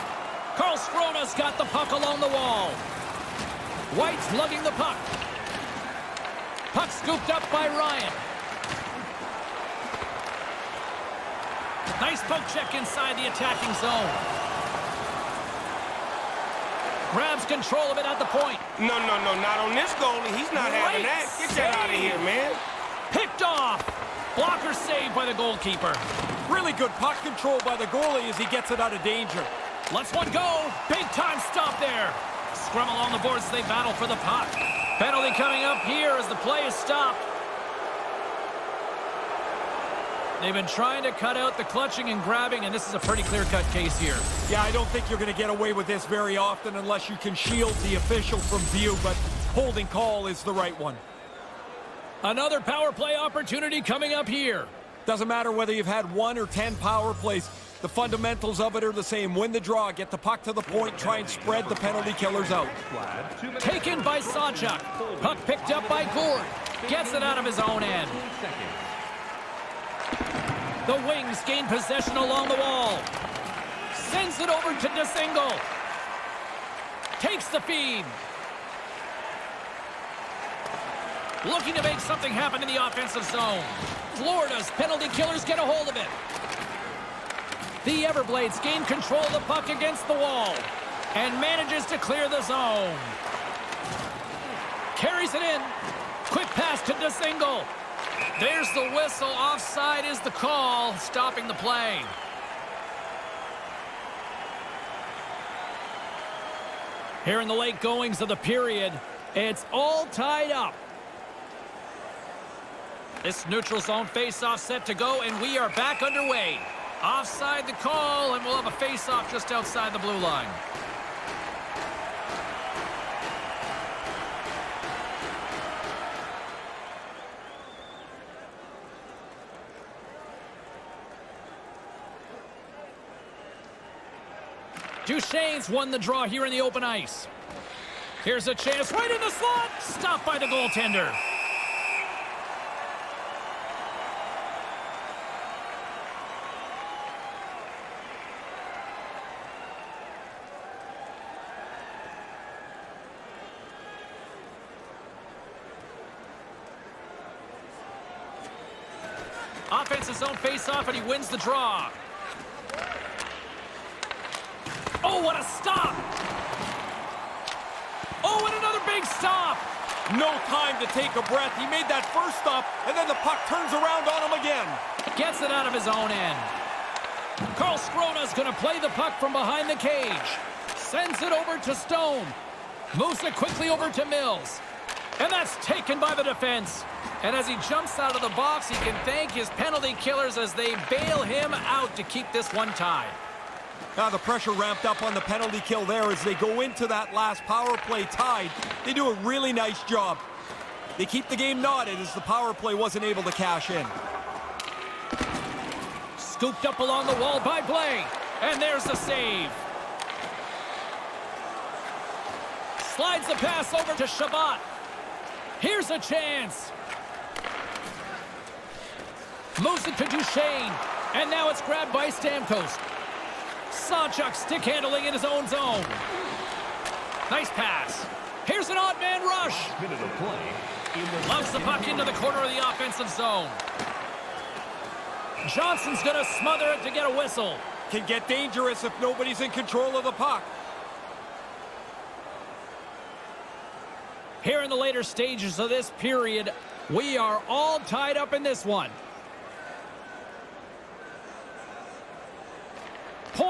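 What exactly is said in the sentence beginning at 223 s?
Sanchuk stick handling in his own zone.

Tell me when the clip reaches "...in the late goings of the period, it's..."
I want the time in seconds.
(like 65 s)
107 s.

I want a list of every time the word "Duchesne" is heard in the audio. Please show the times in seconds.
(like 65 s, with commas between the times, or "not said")
135 s, 220 s.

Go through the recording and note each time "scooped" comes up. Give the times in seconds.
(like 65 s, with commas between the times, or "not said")
6 s, 206 s.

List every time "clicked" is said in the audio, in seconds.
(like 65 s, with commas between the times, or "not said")
not said.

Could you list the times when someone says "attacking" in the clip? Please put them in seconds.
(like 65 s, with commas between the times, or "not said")
13 s.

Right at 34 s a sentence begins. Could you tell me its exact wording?
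Penalty coming up here as the play is stopped.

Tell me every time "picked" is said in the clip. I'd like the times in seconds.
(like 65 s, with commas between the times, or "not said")
23 s, 65 s.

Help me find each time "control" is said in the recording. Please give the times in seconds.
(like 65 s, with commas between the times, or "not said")
17 s, 27 s, 88 s, 239 s.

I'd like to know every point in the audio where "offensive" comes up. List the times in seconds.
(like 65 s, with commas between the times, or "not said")
82 s, 232 s.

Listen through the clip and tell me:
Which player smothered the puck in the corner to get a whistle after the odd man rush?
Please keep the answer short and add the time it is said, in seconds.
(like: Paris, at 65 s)
Johnson, at 235 s.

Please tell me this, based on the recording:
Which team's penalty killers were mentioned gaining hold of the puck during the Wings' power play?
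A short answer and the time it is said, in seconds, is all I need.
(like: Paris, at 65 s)
Florida, at 84 s.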